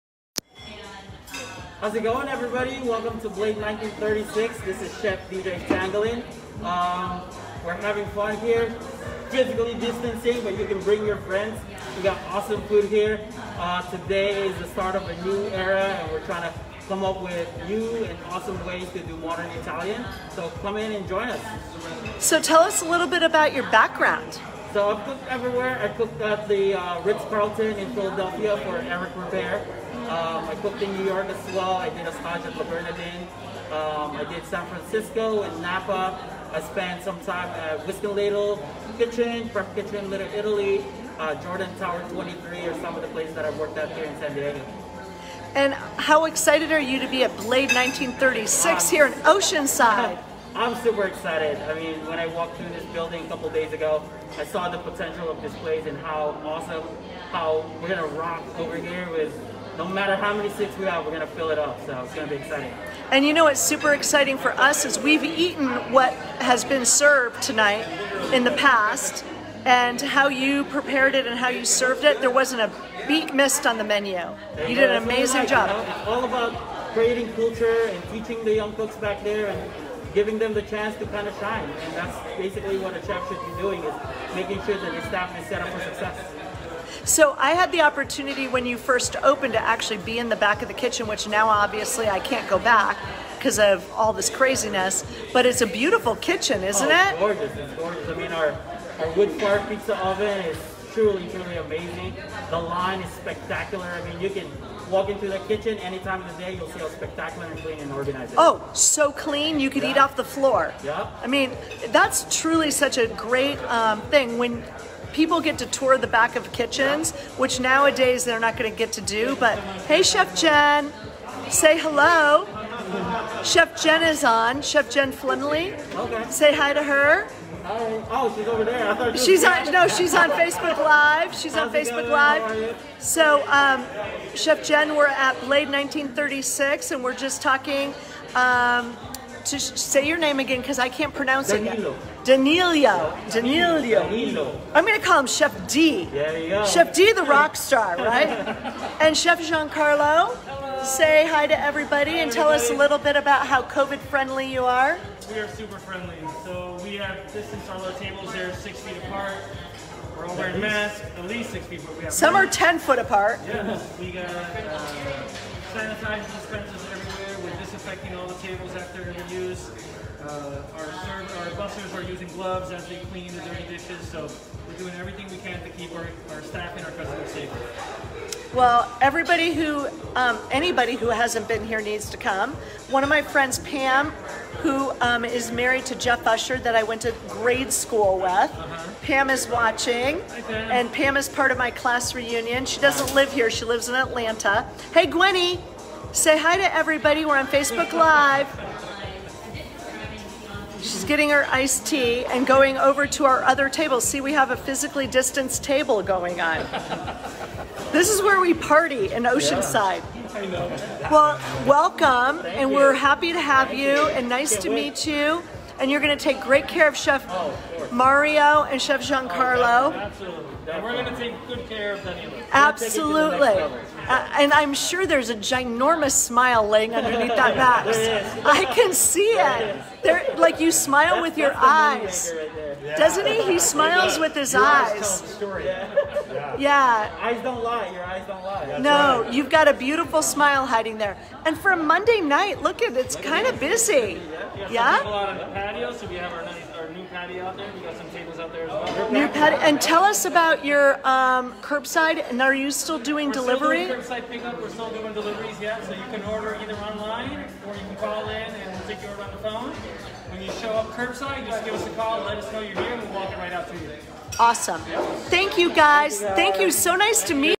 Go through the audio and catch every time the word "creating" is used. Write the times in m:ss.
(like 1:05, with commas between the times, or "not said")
1:16.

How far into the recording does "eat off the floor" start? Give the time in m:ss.
1:49.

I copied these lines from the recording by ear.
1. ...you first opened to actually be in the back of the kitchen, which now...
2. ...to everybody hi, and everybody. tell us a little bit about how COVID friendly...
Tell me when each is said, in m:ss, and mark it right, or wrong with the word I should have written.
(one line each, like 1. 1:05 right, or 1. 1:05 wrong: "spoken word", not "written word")
1. 1:28 right
2. 2:31 right.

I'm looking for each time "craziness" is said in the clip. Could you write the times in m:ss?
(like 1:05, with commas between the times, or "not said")
1:34.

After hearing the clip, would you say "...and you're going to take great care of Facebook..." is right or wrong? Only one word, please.
wrong.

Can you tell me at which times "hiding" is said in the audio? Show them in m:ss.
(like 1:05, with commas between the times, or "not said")
4:00.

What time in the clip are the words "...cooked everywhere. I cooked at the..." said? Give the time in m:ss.
0:25.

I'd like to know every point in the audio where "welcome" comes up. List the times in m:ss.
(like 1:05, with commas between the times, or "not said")
0:02, 3:31.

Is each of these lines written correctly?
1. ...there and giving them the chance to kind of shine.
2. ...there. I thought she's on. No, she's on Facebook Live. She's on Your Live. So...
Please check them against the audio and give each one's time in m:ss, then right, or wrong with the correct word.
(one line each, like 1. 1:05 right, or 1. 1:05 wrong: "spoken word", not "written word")
1. 1:19 right
2. 2:08 wrong: "Facebook", not "Your".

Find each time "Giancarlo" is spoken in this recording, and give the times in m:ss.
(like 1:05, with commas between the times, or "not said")
2:29, 3:39.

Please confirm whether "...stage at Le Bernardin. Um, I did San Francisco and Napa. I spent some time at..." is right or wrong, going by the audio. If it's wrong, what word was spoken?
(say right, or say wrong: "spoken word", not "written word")
right.